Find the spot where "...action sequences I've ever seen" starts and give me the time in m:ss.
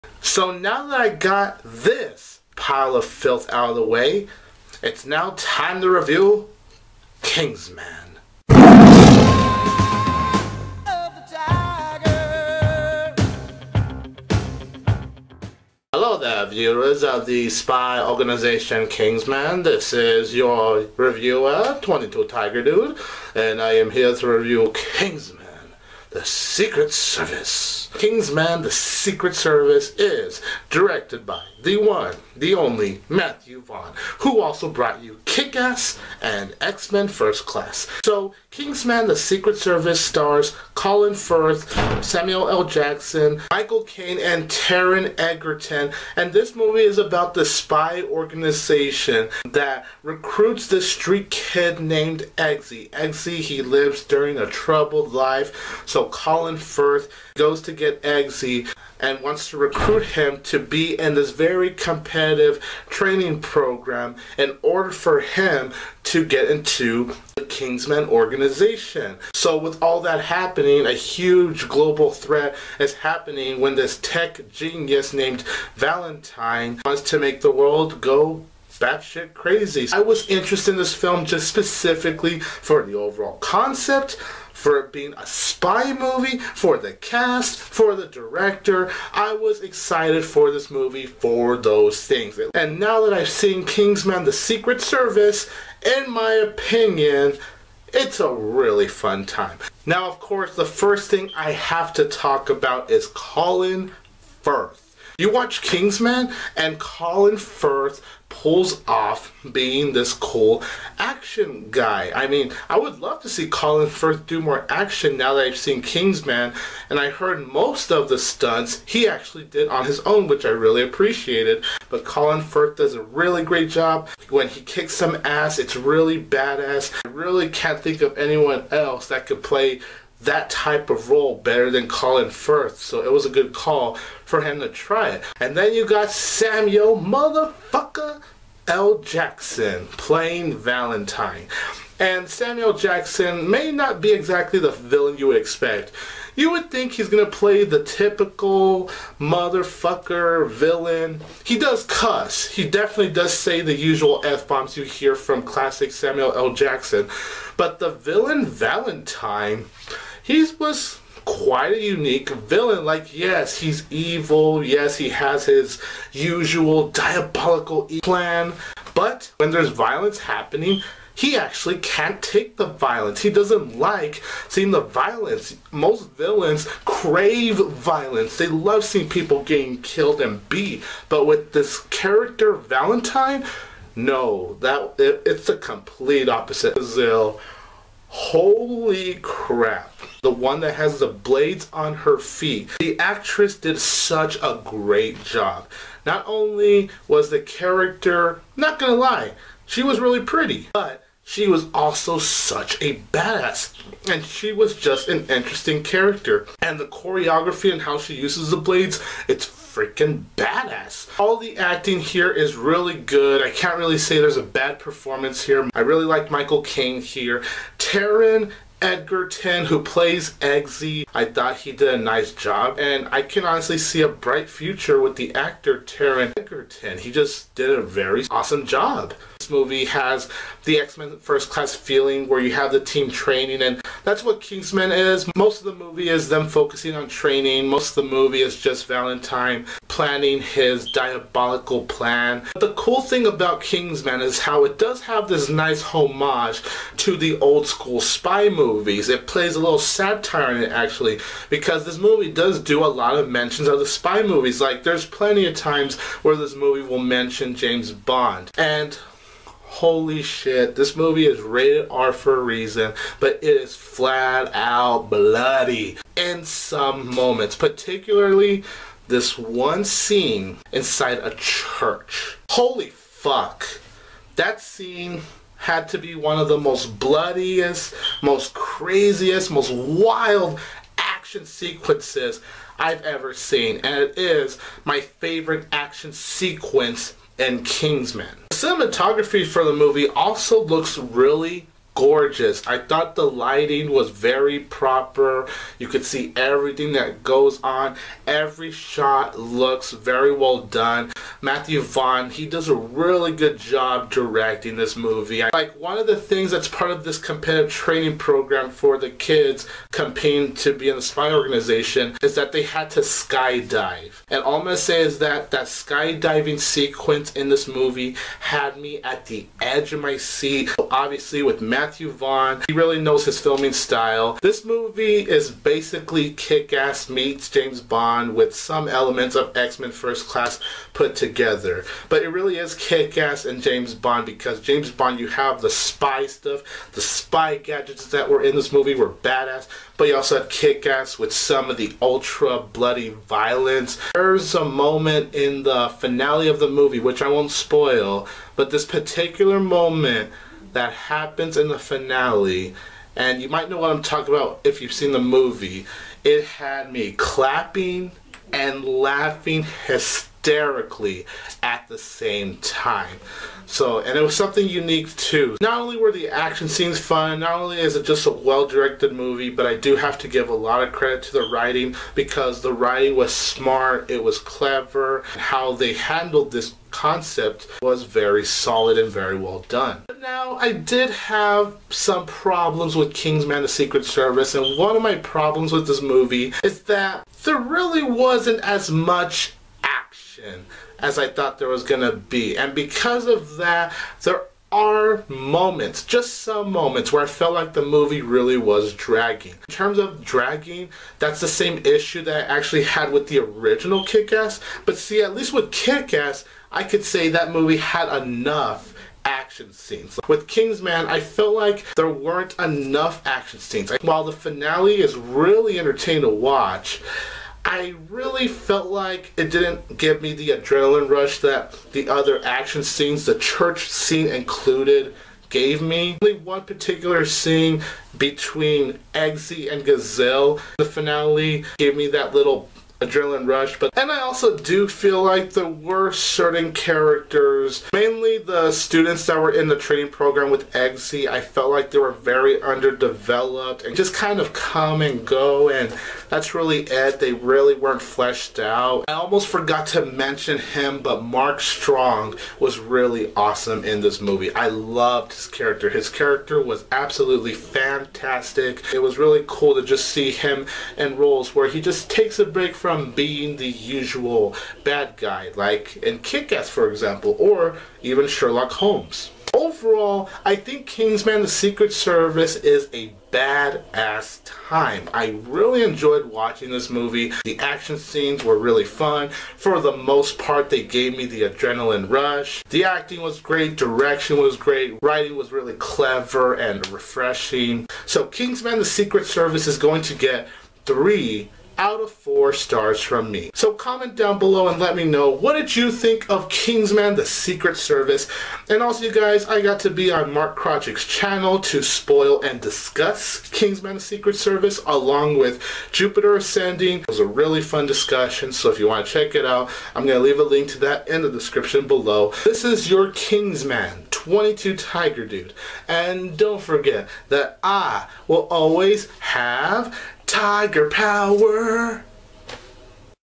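4:40.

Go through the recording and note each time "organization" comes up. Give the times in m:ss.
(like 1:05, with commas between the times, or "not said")
0:18, 0:48, 1:08, 5:11.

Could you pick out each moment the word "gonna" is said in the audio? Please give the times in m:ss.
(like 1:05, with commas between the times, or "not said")
2:27, 3:18, 5:14.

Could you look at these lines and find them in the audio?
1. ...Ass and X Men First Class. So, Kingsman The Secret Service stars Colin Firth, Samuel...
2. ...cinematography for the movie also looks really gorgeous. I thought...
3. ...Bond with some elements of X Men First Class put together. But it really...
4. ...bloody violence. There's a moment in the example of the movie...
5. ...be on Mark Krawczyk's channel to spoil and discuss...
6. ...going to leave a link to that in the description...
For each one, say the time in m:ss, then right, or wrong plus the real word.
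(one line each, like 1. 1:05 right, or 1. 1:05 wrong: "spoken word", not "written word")
1. 0:35 right
2. 4:48 right
3. 5:27 right
4. 5:42 wrong: "finale", not "example"
5. 8:19 right
6. 8:30 right.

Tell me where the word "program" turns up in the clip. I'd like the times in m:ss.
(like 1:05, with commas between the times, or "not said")
1:03, 5:08, 7:20.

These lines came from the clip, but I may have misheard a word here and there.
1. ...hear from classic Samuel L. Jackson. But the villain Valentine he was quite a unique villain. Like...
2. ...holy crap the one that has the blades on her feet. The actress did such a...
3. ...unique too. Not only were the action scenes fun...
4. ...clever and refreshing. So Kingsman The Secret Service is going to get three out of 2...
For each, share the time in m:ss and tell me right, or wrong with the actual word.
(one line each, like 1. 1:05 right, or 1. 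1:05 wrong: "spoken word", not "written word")
1. 2:34 right
2. 3:08 right
3. 6:04 right
4. 8:05 wrong: "4", not "2".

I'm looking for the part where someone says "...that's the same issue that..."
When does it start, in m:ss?
6:41.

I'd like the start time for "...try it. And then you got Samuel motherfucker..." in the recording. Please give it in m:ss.
2:14.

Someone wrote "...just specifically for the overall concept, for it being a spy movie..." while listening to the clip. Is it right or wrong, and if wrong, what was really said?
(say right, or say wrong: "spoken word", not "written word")
right.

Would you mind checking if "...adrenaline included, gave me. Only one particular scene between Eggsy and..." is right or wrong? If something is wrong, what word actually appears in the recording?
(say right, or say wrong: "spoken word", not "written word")
wrong: "scene", not "adrenaline".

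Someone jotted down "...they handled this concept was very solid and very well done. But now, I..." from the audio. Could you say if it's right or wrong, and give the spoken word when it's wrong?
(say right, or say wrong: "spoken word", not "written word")
right.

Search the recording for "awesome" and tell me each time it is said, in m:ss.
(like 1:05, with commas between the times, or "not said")
3:48, 7:33.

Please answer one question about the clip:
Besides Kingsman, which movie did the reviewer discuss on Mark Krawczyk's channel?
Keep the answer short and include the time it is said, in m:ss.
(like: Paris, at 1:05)
Jupiter Ascending, at 8:25.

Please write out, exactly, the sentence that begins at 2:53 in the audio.
He doesn't like seeing the violence.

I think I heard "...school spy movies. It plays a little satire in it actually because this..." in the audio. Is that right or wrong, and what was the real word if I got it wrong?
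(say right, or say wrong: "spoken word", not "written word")
right.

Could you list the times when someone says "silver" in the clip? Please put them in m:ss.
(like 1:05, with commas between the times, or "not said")
not said.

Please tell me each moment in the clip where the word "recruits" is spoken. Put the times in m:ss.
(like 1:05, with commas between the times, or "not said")
0:50, 0:59.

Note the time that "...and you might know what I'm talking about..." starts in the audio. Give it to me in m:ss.
5:53.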